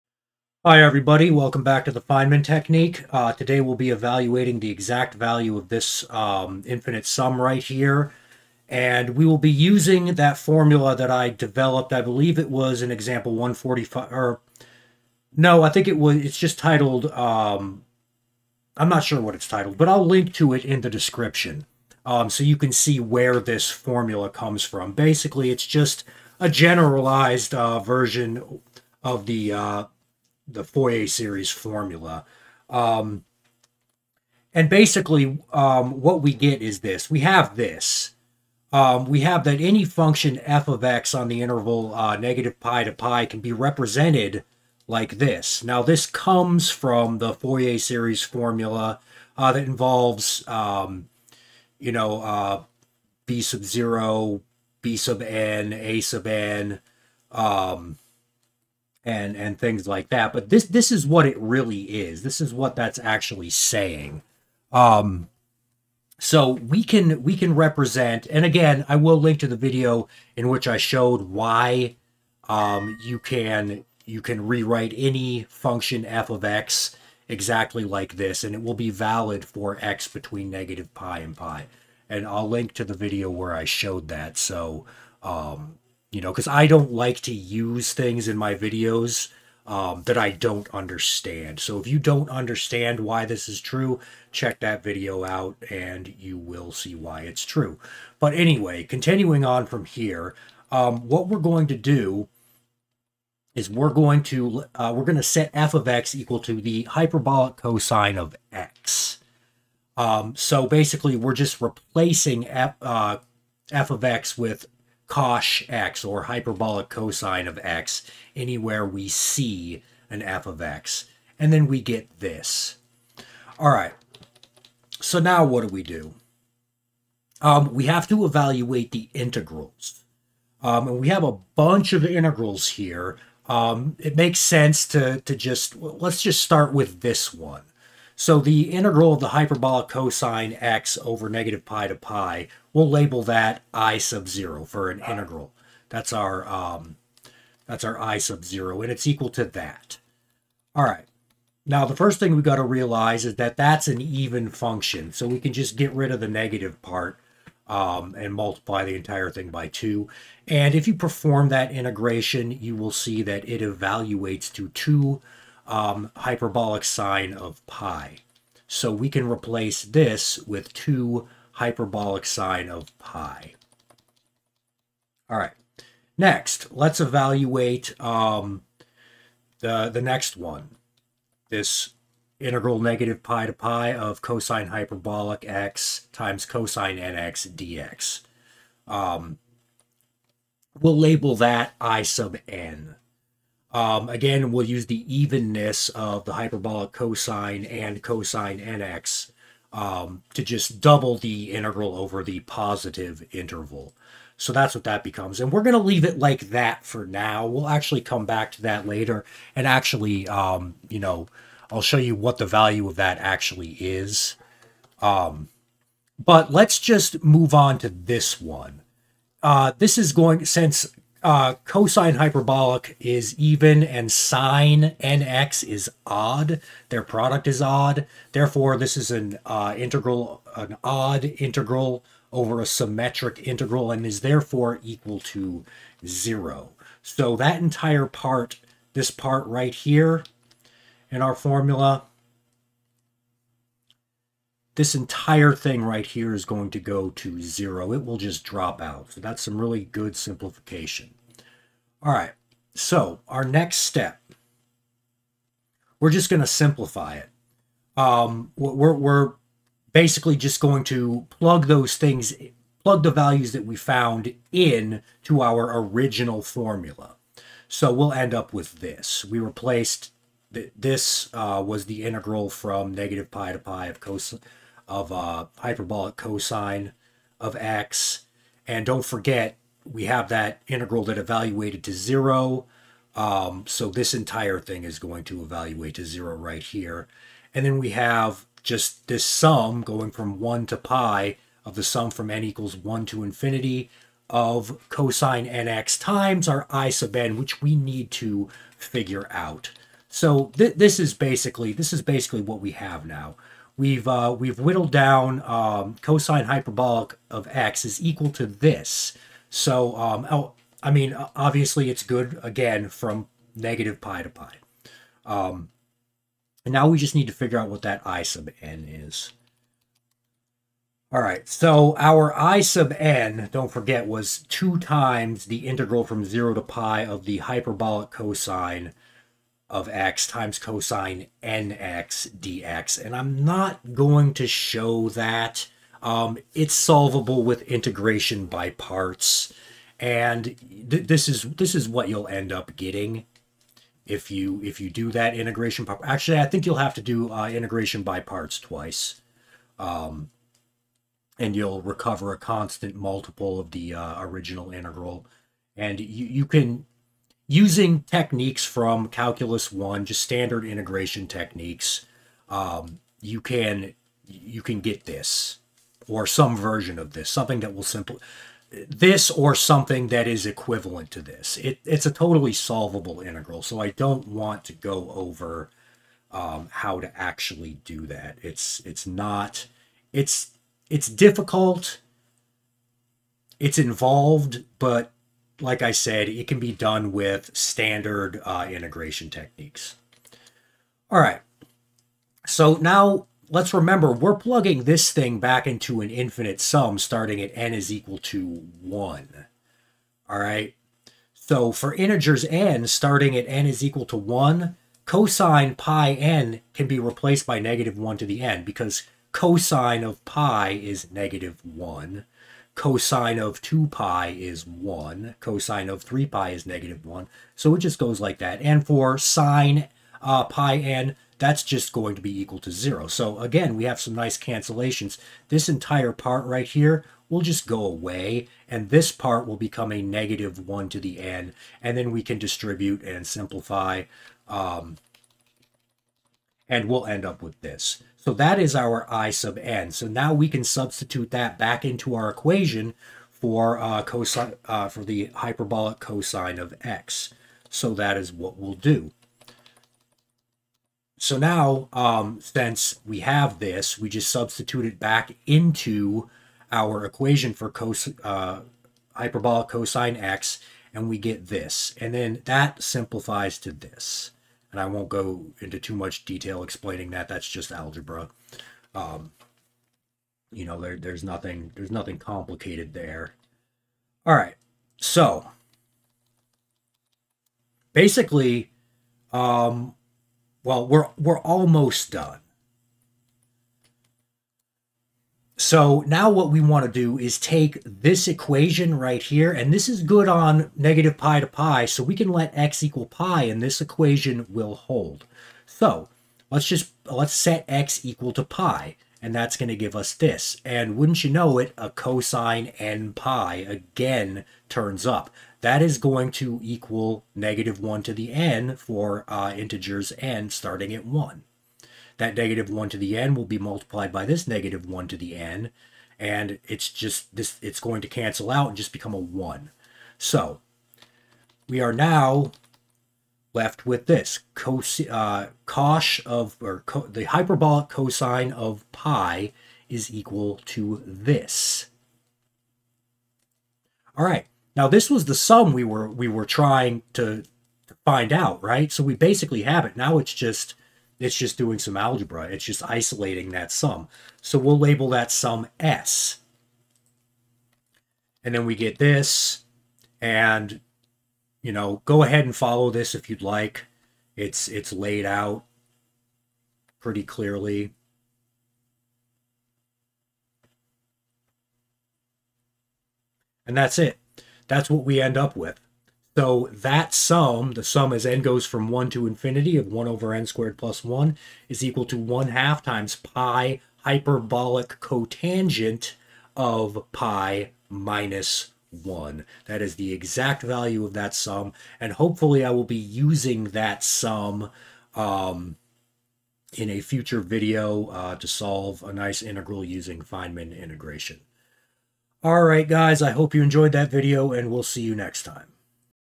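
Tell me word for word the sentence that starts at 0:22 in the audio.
Um, so you can see where this formula comes from.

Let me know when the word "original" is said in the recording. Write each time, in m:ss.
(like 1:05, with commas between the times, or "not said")
4:25, 5:54.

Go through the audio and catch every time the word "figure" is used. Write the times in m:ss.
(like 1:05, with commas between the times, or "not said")
4:58, 5:17.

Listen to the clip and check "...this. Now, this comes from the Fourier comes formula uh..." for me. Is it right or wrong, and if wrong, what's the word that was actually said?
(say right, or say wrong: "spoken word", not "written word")
wrong: "series", not "comes".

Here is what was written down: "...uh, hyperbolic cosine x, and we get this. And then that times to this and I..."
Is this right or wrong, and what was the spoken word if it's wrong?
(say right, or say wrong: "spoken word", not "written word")
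wrong: "simplifies", not "times".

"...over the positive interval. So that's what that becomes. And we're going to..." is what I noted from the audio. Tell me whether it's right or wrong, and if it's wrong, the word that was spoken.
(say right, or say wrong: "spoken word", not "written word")
right.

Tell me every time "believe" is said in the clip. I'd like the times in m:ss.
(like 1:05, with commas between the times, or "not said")
0:12.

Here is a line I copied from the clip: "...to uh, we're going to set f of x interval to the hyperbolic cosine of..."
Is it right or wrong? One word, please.
wrong.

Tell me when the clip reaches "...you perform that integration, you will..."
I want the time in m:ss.
2:40.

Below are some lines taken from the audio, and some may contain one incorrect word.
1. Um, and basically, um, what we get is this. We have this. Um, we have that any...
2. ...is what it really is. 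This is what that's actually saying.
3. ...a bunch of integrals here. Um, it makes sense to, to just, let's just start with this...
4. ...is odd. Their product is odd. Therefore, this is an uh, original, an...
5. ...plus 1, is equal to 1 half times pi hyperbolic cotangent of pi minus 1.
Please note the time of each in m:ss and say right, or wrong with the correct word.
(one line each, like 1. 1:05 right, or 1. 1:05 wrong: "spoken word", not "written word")
1. 0:32 right
2. 1:00 right
3. 2:11 right
4. 3:45 wrong: "integral", not "original"
5. 9:30 right.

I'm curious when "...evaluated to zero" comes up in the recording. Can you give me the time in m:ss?
4:41.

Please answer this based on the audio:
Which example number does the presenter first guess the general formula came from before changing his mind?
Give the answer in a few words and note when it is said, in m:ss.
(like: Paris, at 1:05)
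145, at 0:12.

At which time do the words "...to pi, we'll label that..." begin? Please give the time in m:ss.
2:21.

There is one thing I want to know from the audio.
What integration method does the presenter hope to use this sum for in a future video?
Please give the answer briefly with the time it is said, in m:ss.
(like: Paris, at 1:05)
Feynman integration, at 9:50.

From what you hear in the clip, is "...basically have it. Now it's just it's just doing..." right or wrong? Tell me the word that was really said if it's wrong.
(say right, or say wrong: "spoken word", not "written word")
right.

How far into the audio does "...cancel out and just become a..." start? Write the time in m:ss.
8:38.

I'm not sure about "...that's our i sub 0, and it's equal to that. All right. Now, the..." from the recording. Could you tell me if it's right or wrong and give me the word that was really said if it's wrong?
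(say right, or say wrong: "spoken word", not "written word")
right.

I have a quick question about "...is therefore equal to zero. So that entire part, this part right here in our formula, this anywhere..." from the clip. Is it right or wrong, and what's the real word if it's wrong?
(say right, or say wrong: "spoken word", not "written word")
wrong: "entire", not "anywhere".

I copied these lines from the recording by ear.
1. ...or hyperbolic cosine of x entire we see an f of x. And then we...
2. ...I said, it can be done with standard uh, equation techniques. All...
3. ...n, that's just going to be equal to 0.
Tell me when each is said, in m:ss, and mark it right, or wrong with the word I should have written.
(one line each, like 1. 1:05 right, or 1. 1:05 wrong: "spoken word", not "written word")
1. 1:56 wrong: "anywhere", not "entire"
2. 6:25 wrong: "integration", not "equation"
3. 7:00 right.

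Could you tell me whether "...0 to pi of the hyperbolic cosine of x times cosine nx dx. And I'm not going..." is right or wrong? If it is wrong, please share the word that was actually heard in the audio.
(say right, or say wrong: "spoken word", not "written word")
right.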